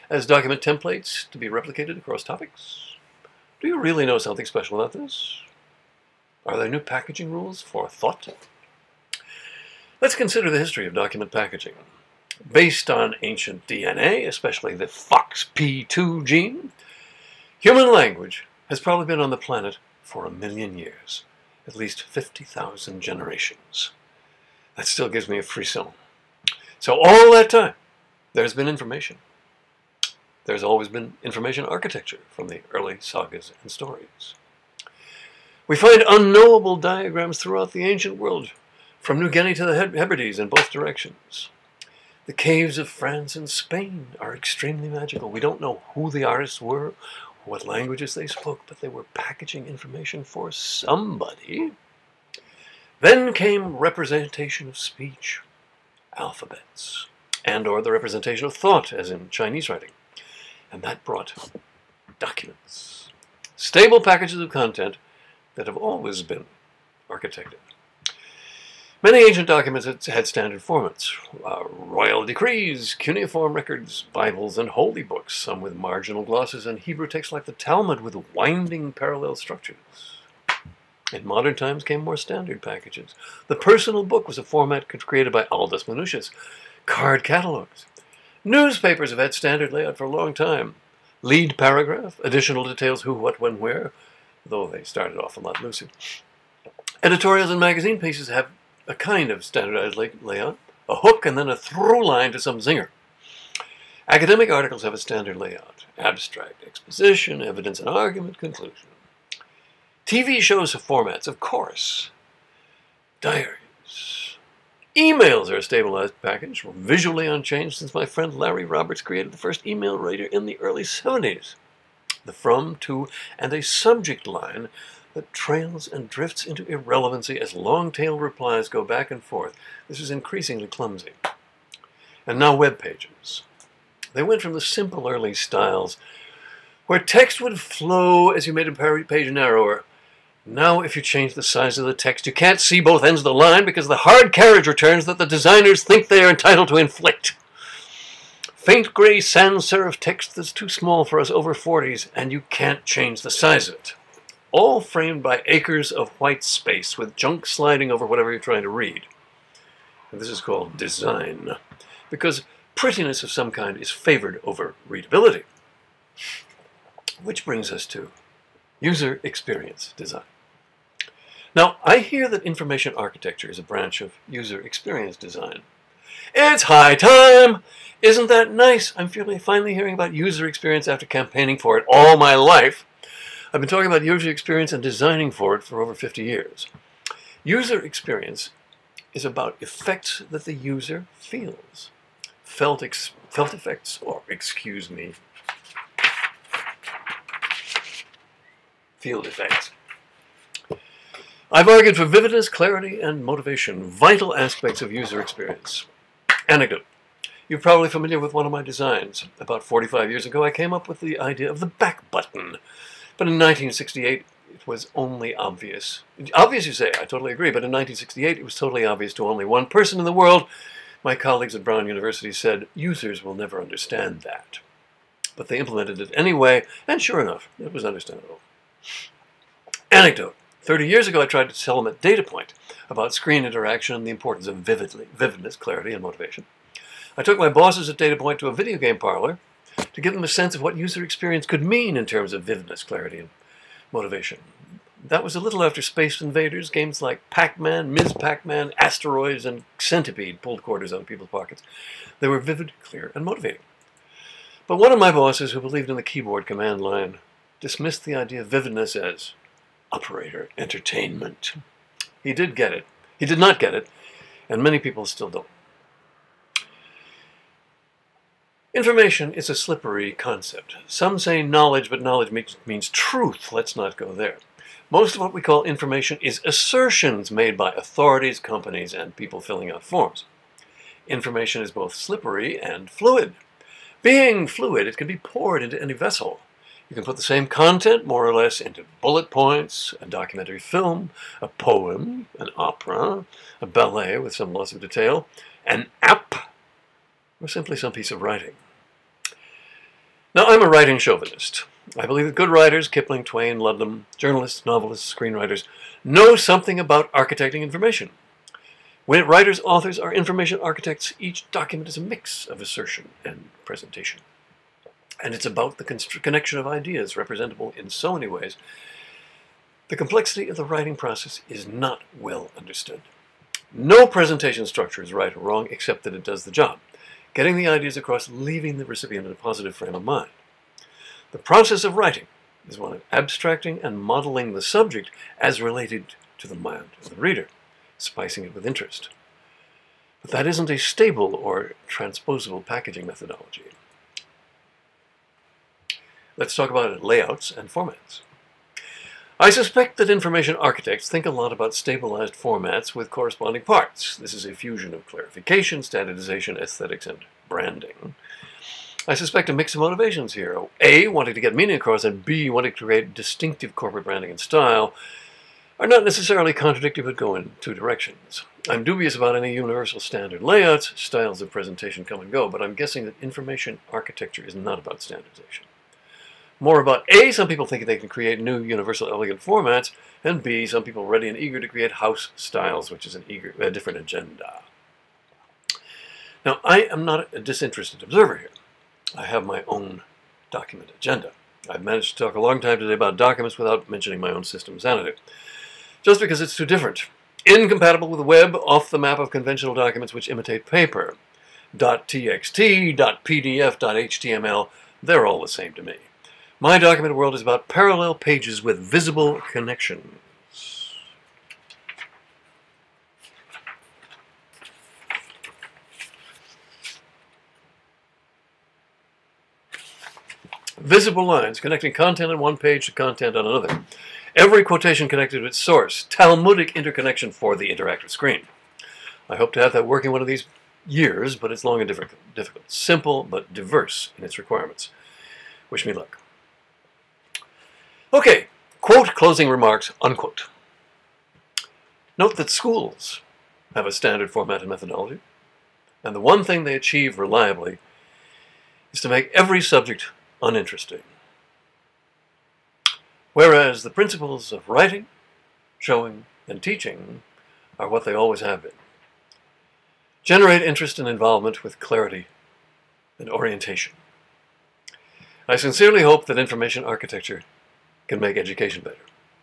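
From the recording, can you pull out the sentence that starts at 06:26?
Now, I am not a disinterested observer here.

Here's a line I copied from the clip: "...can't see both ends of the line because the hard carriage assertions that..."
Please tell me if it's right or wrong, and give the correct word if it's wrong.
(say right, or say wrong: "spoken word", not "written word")
wrong: "returns", not "assertions".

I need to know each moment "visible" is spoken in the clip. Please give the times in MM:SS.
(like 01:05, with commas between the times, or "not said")
06:48, 07:00.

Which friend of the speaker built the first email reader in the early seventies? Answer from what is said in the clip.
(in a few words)
Larry Roberts.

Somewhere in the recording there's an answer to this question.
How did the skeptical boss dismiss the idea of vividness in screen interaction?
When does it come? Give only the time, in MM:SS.
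04:19.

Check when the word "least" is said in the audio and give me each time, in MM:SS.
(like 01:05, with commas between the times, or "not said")
00:21.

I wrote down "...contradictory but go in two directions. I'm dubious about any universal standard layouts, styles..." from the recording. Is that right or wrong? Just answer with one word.
right.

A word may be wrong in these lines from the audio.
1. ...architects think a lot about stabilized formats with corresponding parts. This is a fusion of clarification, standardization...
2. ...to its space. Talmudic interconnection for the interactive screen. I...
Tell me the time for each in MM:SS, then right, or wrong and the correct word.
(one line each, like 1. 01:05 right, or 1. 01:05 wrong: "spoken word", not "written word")
1. 05:50 right
2. 07:05 wrong: "source", not "space".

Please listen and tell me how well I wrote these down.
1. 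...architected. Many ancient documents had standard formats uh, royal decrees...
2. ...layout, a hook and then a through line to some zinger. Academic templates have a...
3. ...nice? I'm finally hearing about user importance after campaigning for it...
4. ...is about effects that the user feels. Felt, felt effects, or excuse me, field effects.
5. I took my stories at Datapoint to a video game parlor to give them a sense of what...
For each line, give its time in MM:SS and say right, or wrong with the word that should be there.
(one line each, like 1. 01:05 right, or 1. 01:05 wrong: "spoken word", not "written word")
1. 01:07 right
2. 01:40 wrong: "articles", not "templates"
3. 02:58 wrong: "experience", not "importance"
4. 03:09 right
5. 03:57 wrong: "bosses", not "stories".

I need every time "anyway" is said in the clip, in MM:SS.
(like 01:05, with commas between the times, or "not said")
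03:46.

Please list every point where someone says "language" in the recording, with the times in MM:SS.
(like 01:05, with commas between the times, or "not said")
00:17, 00:47.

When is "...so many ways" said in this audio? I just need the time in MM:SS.
05:17.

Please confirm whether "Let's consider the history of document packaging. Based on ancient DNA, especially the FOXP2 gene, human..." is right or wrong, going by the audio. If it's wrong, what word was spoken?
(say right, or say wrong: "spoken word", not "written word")
right.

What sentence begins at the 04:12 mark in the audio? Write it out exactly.
They were vivid, clear, and motivating.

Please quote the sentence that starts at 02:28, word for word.
Faint gray sans serif text that's too small for us over 40s, and you can't change the size of it.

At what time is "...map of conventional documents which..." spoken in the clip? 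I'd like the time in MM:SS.
06:38.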